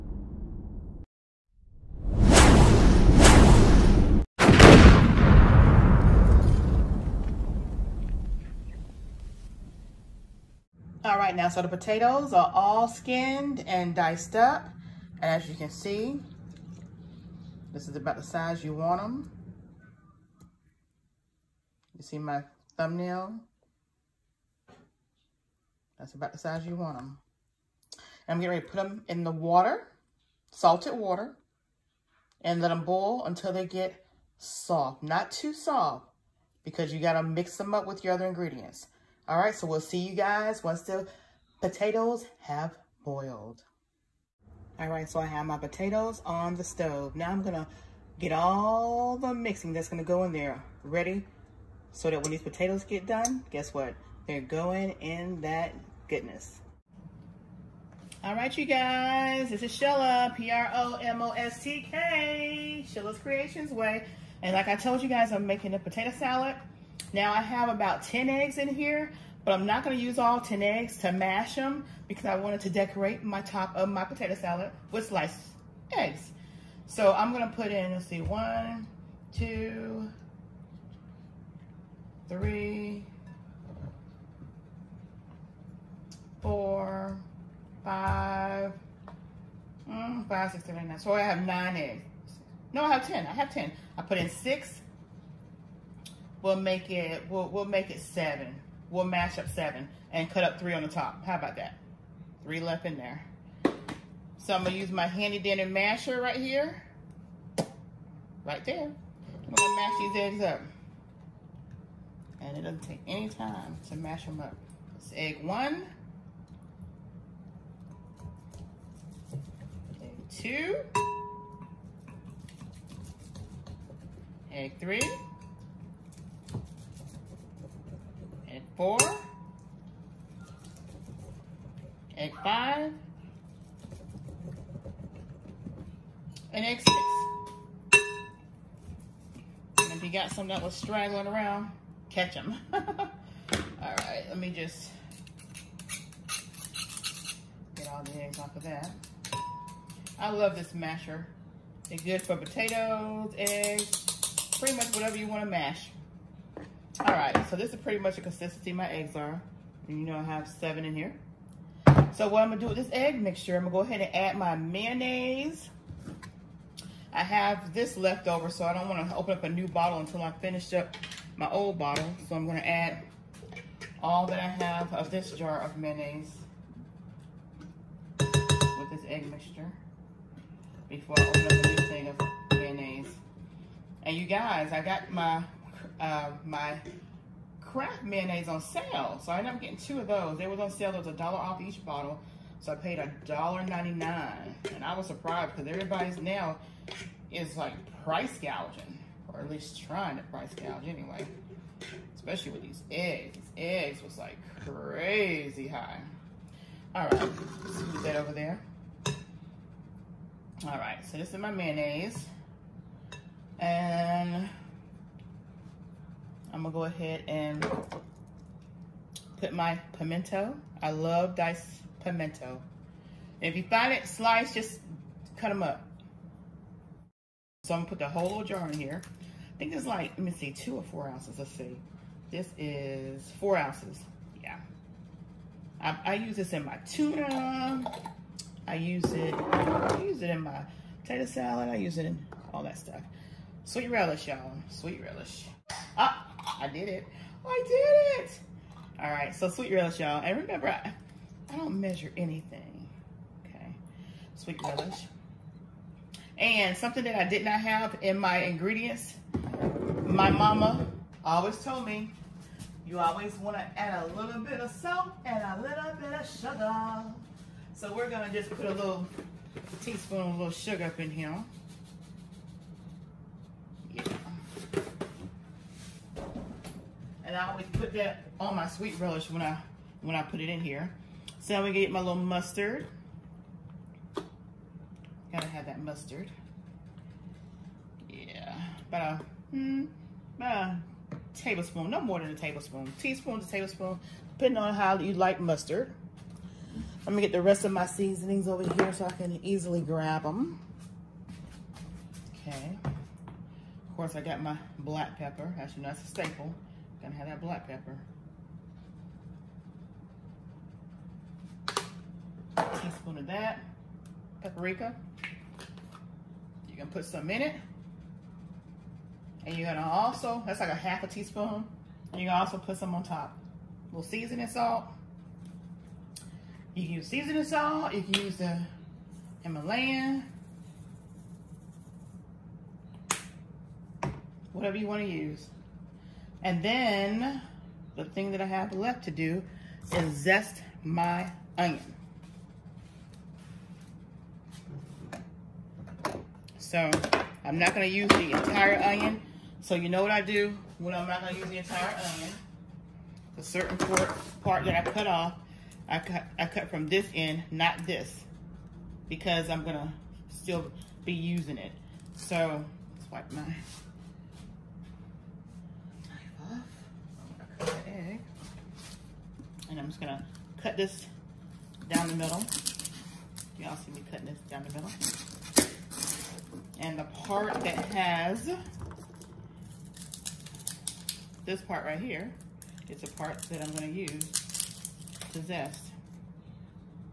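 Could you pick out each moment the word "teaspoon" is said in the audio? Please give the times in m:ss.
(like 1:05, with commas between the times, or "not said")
4:29, 4:52, 5:12, 5:21.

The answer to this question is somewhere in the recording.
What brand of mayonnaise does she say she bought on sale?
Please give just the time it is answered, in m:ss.
3:07.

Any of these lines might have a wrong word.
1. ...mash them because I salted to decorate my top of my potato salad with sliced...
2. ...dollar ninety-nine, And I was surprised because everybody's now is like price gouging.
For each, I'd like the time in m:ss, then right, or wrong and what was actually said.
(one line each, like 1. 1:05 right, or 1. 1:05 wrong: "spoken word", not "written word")
1. 1:11 wrong: "wanted", not "salted"
2. 3:13 right.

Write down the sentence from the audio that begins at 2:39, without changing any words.
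And you know I have seven in here.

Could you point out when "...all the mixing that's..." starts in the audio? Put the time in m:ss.
0:48.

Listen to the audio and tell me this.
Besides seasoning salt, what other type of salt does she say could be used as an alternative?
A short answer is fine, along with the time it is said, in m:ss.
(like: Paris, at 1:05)
Himalayan, at 5:29.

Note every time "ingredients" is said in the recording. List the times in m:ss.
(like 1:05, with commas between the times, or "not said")
0:38, 4:18.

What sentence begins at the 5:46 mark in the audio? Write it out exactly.
So I'm not gonna use the entire onion.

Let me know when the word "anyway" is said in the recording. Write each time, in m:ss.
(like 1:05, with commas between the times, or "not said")
3:20.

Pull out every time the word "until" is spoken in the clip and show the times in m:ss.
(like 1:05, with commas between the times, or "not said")
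0:33, 2:49.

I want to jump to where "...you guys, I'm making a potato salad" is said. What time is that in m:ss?
1:05.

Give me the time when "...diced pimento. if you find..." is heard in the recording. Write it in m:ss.
3:41.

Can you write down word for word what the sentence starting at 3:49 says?
I think it's like, let me see, two or four ounces, let's see.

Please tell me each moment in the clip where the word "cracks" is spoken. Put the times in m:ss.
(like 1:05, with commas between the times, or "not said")
not said.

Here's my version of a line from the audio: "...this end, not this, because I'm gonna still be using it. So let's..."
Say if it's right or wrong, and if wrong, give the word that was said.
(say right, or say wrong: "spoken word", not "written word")
right.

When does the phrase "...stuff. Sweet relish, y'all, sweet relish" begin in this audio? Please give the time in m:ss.
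4:02.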